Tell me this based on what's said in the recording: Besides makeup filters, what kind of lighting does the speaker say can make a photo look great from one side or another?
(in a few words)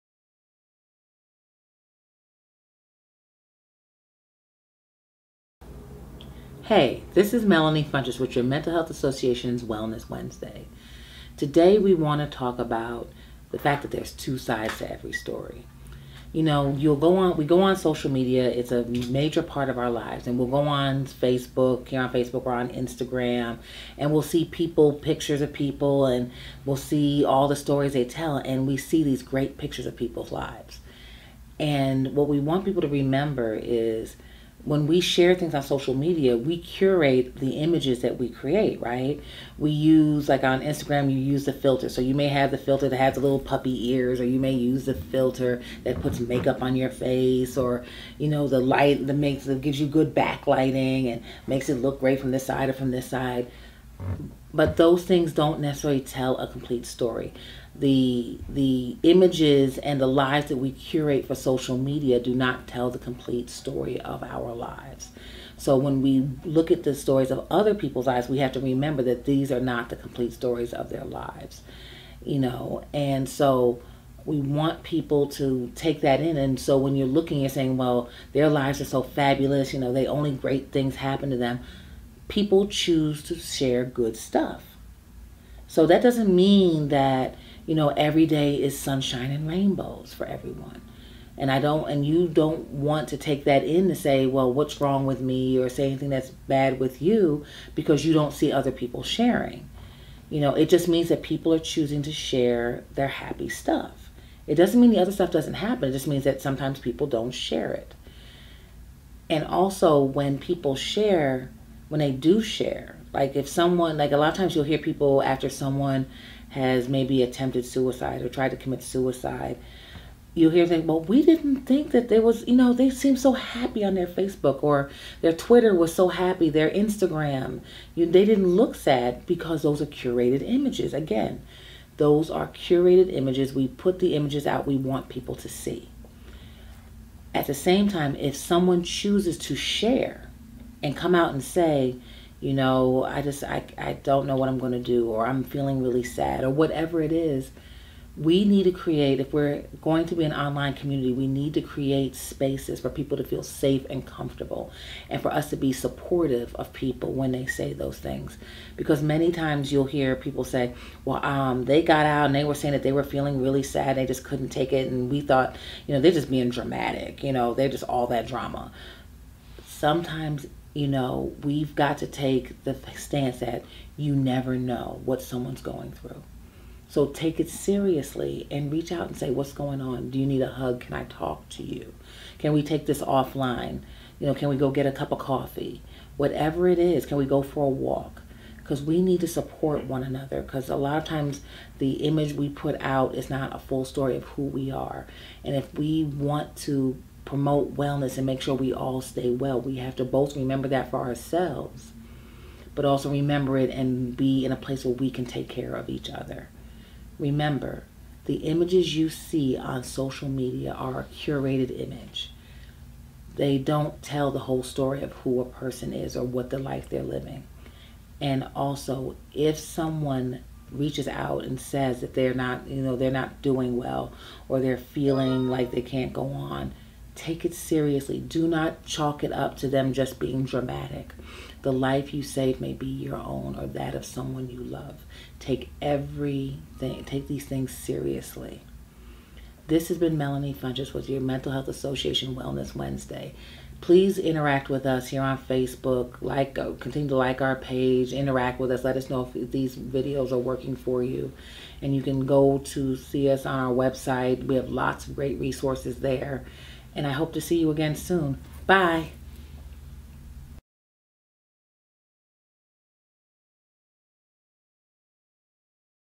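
backlighting.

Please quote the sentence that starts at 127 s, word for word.
You, they didn't look sad because those are curated images.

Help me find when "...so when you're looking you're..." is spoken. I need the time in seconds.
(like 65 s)
76 s.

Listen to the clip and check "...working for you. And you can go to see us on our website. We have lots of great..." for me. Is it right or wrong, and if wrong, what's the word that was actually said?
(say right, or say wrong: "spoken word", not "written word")
right.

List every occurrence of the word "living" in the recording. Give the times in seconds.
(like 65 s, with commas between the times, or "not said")
217 s.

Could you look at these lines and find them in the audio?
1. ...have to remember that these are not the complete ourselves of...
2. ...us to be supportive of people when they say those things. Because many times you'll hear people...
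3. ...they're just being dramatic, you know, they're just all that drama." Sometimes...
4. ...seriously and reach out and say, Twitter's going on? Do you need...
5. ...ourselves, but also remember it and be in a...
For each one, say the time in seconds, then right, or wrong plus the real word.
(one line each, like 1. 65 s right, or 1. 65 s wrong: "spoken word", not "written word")
1. 68 s wrong: "stories", not "ourselves"
2. 155 s right
3. 166 s right
4. 177 s wrong: "What", not "Twitter"
5. 200 s right.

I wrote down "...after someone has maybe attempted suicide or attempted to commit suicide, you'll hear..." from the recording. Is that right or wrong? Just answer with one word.
wrong.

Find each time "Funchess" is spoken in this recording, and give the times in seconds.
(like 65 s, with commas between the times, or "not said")
7 s, 240 s.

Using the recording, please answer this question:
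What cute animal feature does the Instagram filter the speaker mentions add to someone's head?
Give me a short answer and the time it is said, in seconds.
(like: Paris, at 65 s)
puppy ears, at 43 s.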